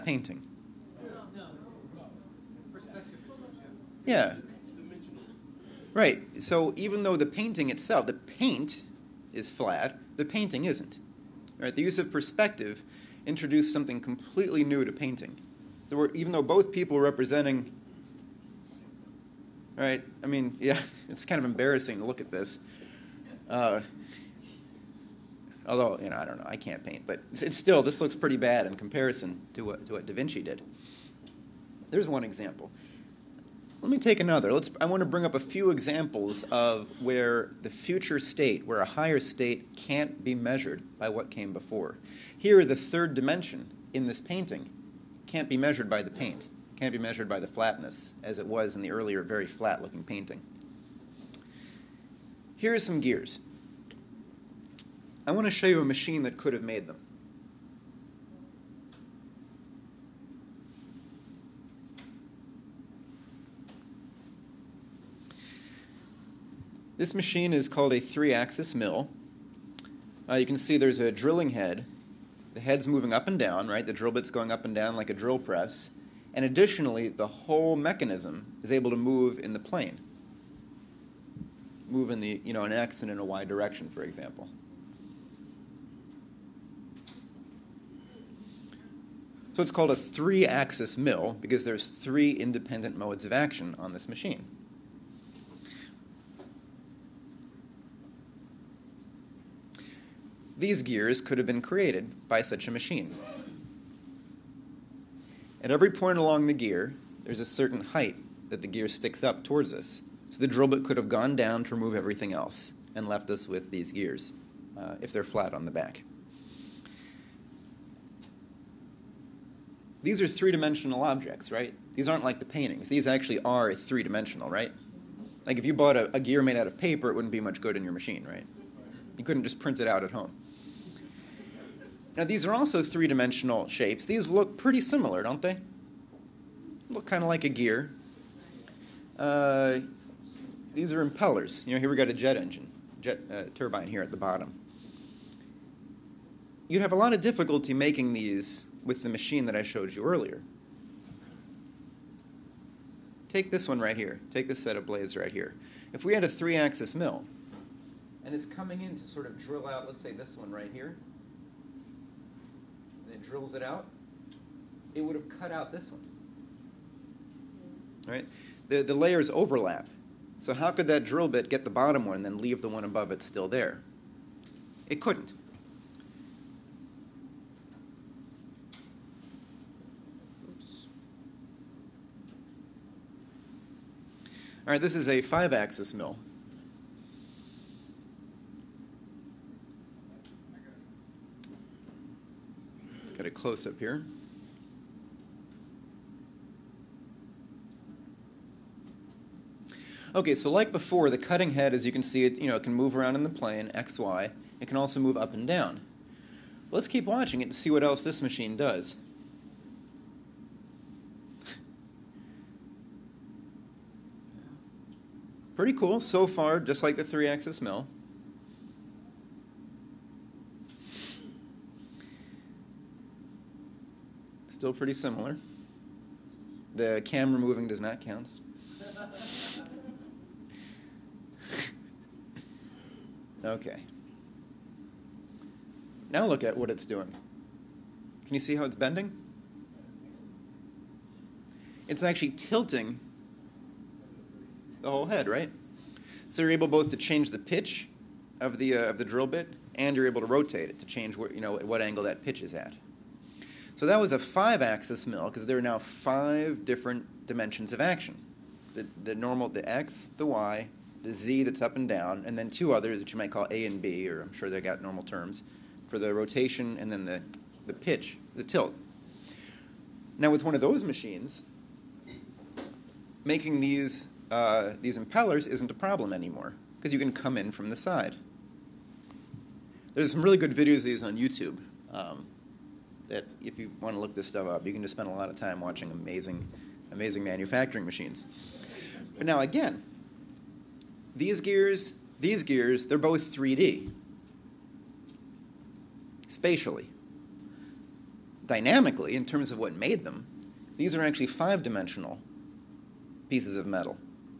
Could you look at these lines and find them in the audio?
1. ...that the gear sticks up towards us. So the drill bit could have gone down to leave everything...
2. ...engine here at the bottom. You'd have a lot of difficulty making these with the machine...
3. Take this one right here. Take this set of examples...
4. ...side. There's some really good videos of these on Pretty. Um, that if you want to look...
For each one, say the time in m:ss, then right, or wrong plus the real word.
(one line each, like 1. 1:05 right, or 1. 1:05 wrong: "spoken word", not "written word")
1. 1:48 wrong: "remove", not "leave"
2. 2:23 wrong: "turbine", not "engine"
3. 2:33 wrong: "blades", not "examples"
4. 4:37 wrong: "YouTube", not "Pretty".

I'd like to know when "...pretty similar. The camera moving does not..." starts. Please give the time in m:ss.
3:44.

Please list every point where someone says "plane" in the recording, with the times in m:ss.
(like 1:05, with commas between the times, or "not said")
1:19, 3:23.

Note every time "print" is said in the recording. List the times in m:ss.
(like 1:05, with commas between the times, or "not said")
2:09.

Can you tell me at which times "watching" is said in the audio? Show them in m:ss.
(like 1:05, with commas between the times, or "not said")
3:27, 4:45.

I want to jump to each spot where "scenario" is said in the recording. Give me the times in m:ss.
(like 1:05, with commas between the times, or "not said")
not said.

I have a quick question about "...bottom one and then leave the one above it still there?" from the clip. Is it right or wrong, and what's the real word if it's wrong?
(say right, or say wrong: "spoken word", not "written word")
right.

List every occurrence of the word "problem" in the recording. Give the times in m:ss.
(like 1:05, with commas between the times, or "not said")
4:35.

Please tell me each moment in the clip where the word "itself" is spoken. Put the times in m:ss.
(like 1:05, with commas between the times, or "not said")
0:07.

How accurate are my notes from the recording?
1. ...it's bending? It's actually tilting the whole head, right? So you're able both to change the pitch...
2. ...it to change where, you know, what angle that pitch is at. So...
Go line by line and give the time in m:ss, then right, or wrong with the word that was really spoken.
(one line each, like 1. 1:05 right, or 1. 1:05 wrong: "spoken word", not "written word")
1. 3:58 right
2. 4:10 right.